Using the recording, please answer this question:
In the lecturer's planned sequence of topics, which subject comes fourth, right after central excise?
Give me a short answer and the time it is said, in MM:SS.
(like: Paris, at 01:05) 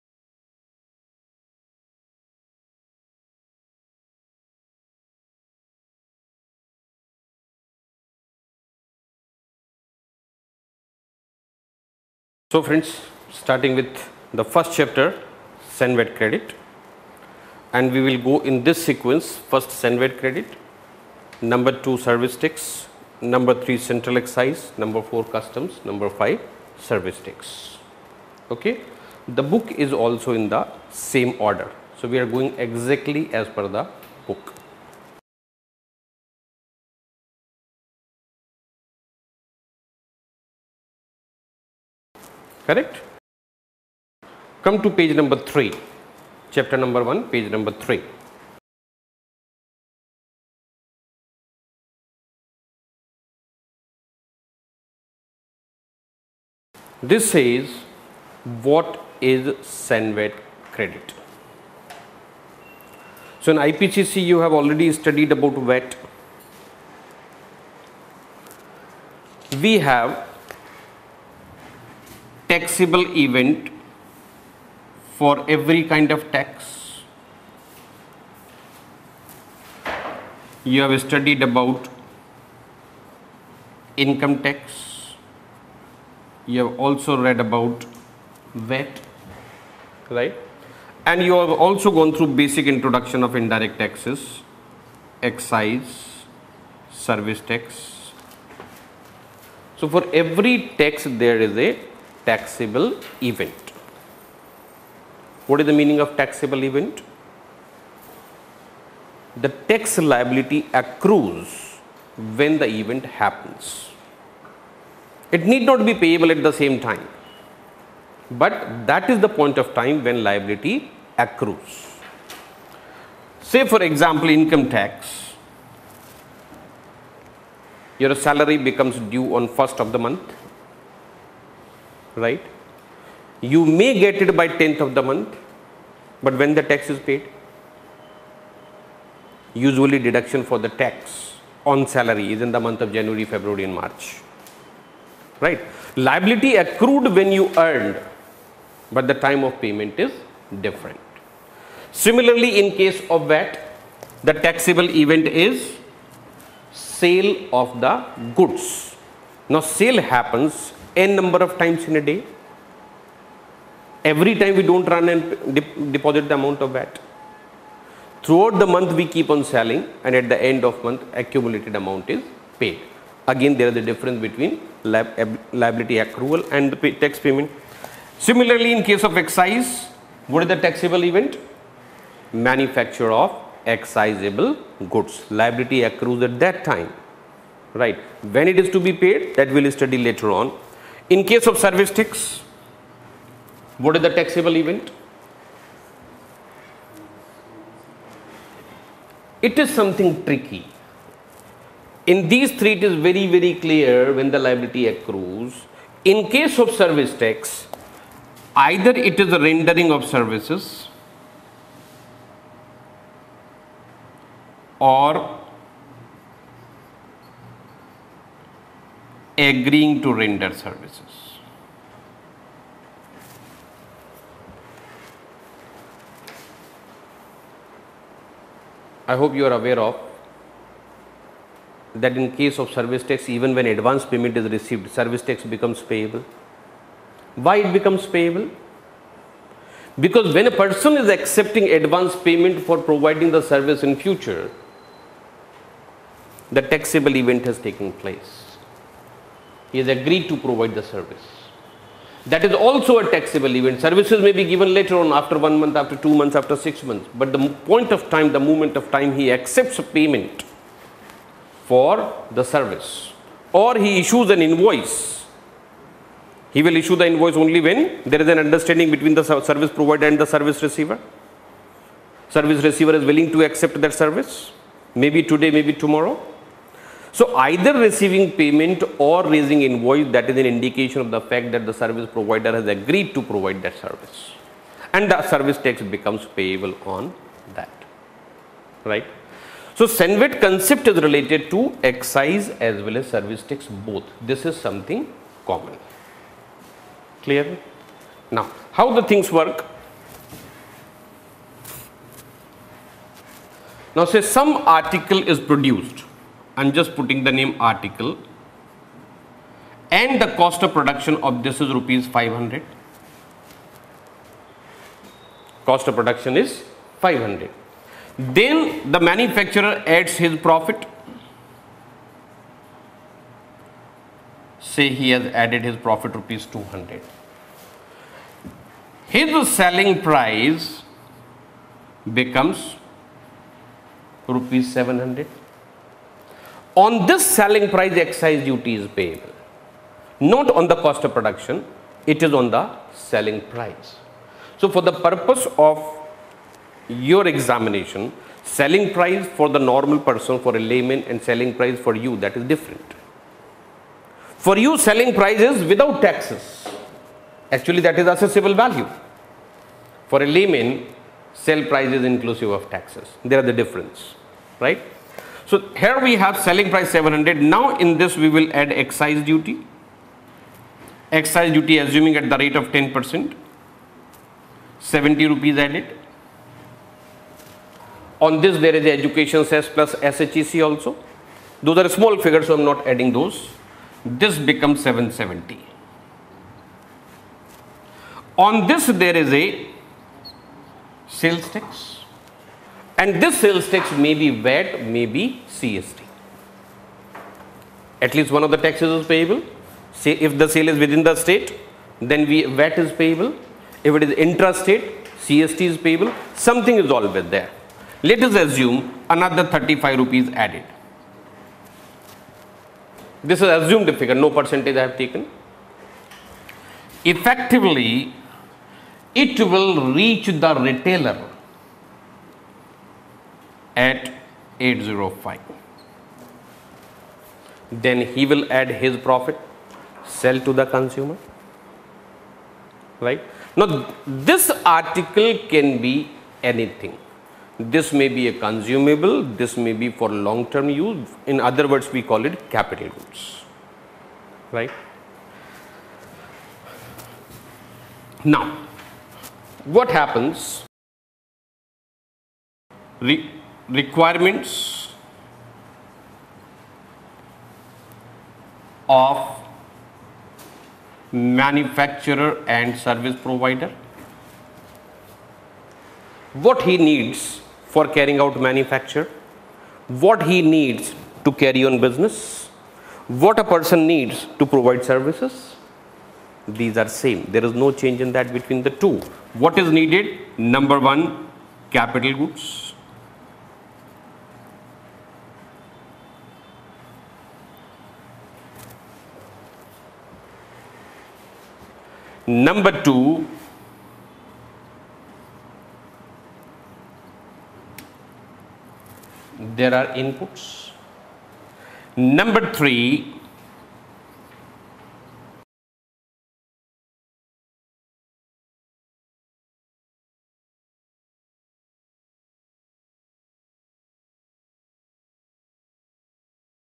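Customs, at 00:25.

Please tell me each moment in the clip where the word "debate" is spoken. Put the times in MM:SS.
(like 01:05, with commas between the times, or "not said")
not said.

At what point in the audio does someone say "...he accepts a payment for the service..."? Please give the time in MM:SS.
04:19.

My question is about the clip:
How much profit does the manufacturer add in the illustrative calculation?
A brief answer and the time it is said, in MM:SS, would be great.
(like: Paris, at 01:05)
200, at 05:26.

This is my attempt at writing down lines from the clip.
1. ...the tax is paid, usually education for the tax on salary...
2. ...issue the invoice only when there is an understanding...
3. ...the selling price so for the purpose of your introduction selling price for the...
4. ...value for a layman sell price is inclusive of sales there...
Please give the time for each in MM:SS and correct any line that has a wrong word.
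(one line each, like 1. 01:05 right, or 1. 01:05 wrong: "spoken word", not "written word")
1. 02:16 wrong: "deduction", not "education"
2. 04:26 right
3. 05:42 wrong: "examination", not "introduction"
4. 05:58 wrong: "taxes", not "sales".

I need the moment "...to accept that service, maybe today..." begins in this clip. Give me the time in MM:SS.
04:33.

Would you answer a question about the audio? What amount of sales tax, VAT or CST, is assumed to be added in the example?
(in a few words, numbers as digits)
35 rupees.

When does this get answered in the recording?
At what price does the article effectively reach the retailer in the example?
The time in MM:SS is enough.
07:04.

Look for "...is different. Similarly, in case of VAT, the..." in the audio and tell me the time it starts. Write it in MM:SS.
02:29.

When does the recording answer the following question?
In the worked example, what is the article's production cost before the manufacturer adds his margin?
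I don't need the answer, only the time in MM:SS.
05:10.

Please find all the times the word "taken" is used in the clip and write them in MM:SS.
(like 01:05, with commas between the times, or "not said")
04:07, 06:54.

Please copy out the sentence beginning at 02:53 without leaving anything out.
Again there is a difference between liability accrual and the pay tax payment.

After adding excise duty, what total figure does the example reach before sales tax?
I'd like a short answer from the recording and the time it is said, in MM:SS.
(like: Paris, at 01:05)
770, at 06:24.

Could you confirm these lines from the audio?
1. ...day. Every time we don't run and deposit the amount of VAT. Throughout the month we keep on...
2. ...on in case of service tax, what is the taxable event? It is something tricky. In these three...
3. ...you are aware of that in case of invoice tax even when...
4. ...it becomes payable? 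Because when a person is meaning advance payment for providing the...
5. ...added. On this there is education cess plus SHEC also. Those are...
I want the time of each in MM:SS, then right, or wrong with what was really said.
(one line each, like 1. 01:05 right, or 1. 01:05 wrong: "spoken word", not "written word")
1. 02:42 right
2. 03:10 right
3. 03:49 wrong: "service", not "invoice"
4. 03:57 wrong: "accepting", not "meaning"
5. 06:15 right.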